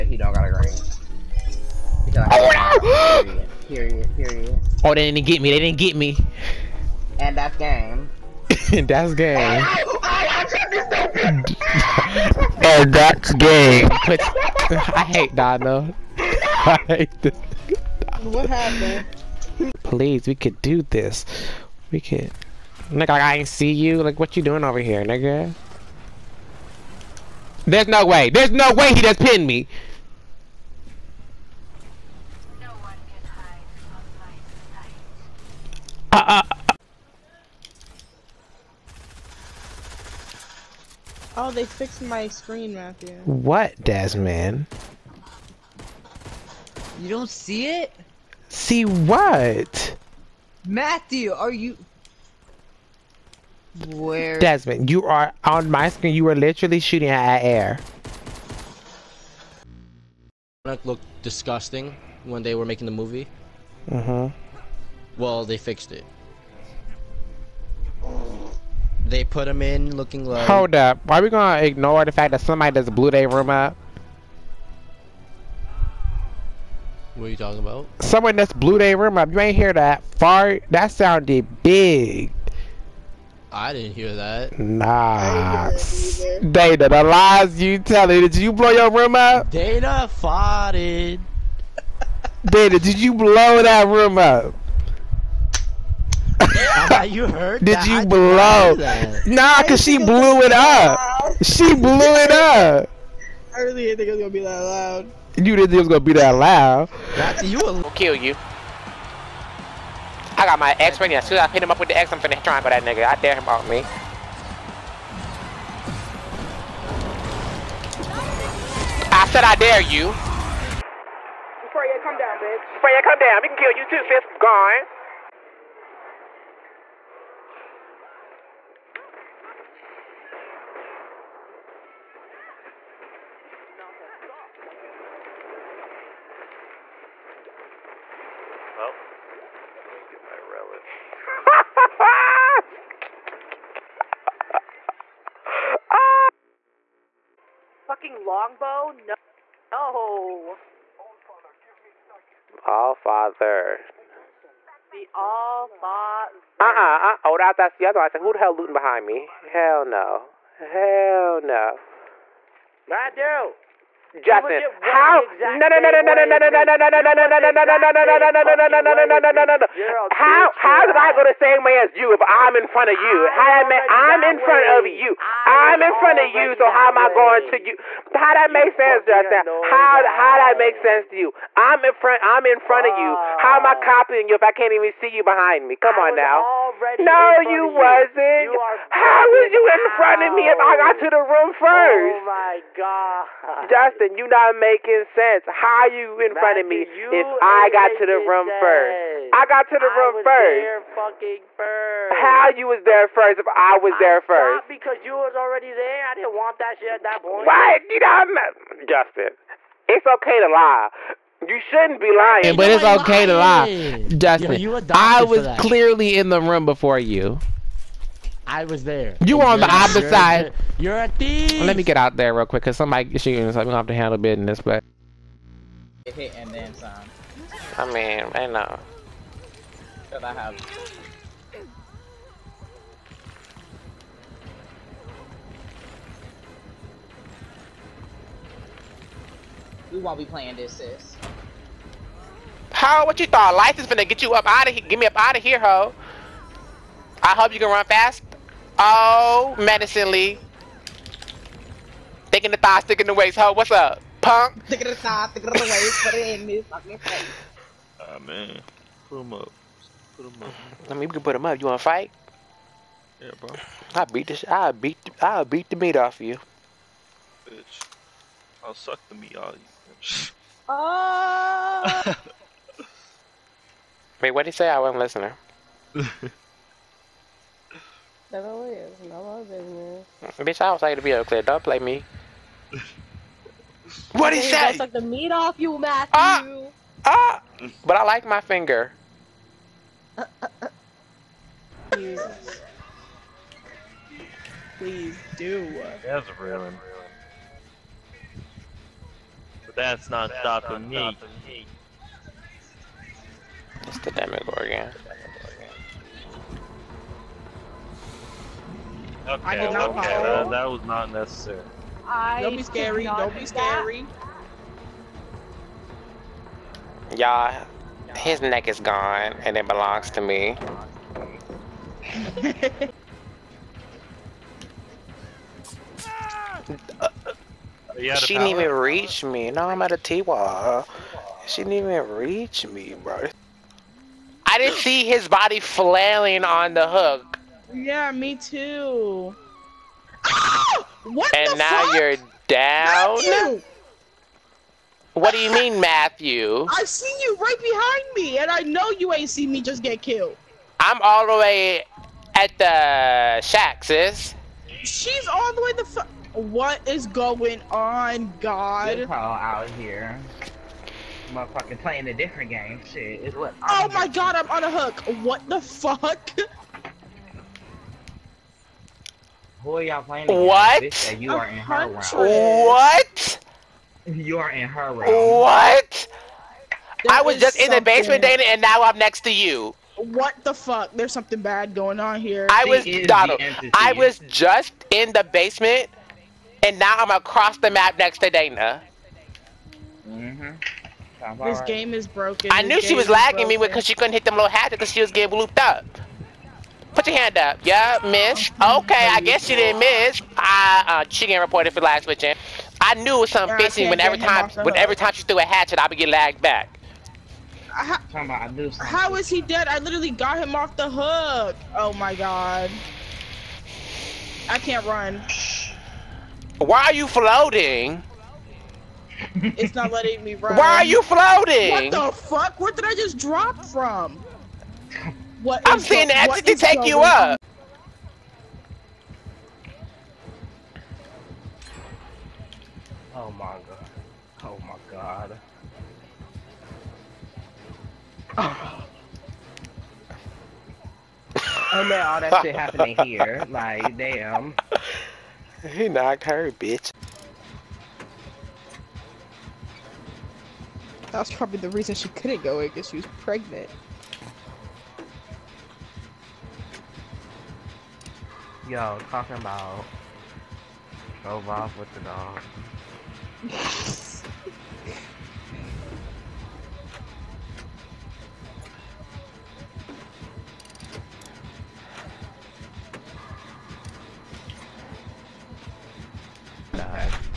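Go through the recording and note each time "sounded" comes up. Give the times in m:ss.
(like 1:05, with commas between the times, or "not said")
1:20.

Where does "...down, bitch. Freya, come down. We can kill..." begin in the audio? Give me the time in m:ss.
2:02.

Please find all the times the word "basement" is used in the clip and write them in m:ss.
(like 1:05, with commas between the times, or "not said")
6:17, 6:25.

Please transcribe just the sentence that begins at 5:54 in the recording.
She's all the way the fuck.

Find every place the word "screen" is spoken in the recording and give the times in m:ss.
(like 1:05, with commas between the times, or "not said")
0:42, 0:55.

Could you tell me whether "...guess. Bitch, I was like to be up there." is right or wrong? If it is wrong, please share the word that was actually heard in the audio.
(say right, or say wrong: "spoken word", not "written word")
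wrong: "business", not "guess".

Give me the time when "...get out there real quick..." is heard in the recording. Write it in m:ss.
3:41.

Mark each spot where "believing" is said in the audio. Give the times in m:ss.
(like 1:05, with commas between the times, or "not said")
not said.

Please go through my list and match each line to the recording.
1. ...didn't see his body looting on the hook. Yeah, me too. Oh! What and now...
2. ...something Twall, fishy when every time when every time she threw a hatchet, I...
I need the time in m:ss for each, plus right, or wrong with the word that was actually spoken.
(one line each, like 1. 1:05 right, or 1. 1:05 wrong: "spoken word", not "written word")
1. 5:34 wrong: "flailing", not "looting"
2. 6:43 wrong: "Girl", not "Twall".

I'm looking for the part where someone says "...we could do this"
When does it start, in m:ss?
0:20.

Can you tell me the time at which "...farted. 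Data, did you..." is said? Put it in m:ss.
1:30.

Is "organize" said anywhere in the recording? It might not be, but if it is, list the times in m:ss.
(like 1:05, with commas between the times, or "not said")
not said.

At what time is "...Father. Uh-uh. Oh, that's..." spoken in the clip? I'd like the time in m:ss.
2:35.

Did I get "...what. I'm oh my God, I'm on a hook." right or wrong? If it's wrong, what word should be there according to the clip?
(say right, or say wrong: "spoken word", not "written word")
right.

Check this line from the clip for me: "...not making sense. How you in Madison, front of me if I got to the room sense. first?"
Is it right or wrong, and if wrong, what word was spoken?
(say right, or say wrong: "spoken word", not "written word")
wrong: "Matthew", not "Madison".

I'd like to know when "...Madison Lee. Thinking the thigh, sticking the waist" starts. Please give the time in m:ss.
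4:09.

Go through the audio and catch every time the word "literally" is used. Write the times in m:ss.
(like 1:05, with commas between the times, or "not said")
0:56, 6:49.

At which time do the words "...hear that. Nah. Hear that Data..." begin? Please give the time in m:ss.
1:23.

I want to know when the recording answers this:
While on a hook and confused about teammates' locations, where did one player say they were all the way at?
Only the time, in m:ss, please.
5:50.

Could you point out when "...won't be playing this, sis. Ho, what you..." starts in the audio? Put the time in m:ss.
3:59.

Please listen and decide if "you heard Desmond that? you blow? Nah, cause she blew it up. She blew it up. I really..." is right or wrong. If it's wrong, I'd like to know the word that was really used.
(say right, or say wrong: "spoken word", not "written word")
wrong: "Did", not "Desmond".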